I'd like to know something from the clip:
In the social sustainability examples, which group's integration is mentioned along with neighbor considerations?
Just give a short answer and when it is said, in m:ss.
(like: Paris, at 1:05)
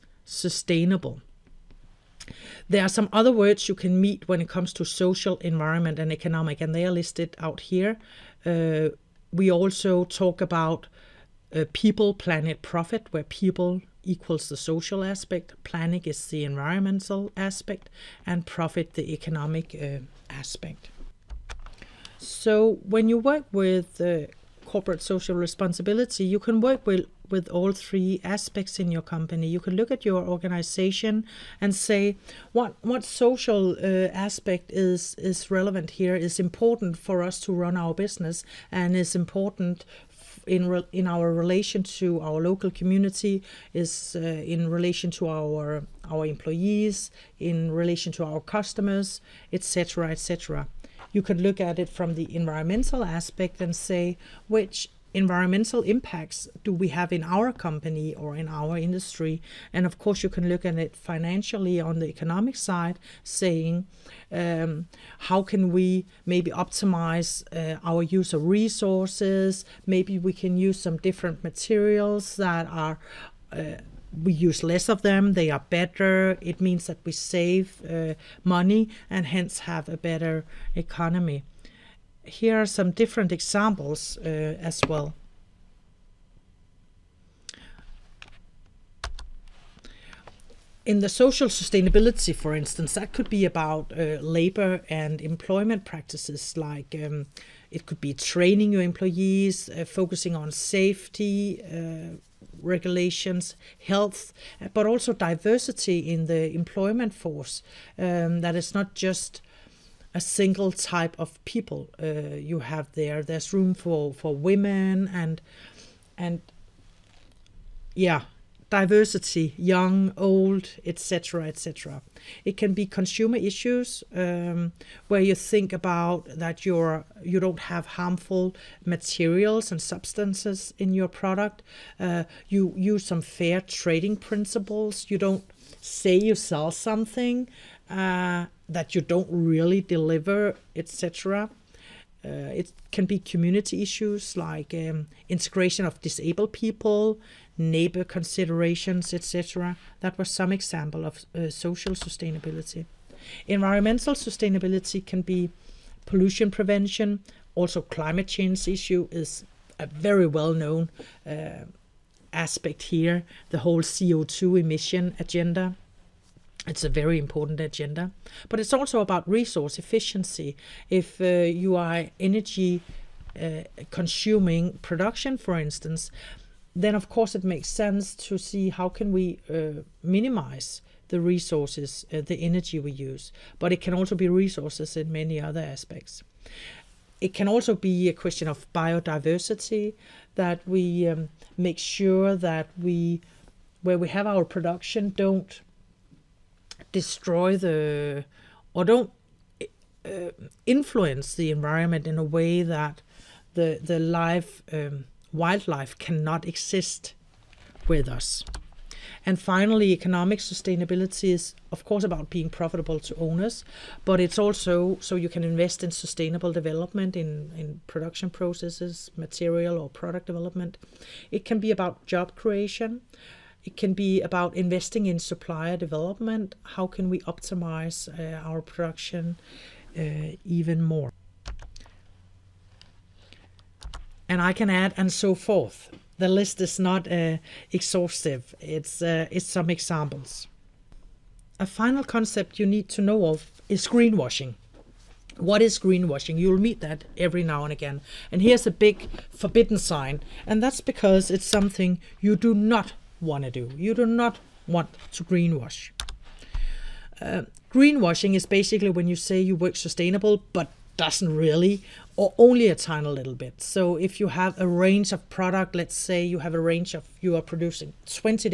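disabled people, at 2:25.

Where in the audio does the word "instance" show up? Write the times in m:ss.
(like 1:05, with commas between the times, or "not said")
1:32, 2:55.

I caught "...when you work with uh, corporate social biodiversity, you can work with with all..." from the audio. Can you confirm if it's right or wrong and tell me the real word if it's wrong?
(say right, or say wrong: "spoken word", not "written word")
wrong: "responsibility", not "biodiversity".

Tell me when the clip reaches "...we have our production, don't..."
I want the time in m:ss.
3:13.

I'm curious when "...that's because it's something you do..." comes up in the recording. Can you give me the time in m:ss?
4:10.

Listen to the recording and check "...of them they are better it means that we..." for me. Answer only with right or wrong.
right.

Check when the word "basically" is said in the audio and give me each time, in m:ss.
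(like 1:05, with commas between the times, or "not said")
4:18.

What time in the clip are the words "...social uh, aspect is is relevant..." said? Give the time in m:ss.
0:33.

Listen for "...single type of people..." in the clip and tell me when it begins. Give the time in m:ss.
1:50.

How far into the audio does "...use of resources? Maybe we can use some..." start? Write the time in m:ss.
1:08.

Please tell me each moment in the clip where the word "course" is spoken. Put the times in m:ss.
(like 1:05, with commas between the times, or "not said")
0:59, 2:57, 3:31.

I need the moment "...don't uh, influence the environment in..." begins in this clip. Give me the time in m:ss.
3:18.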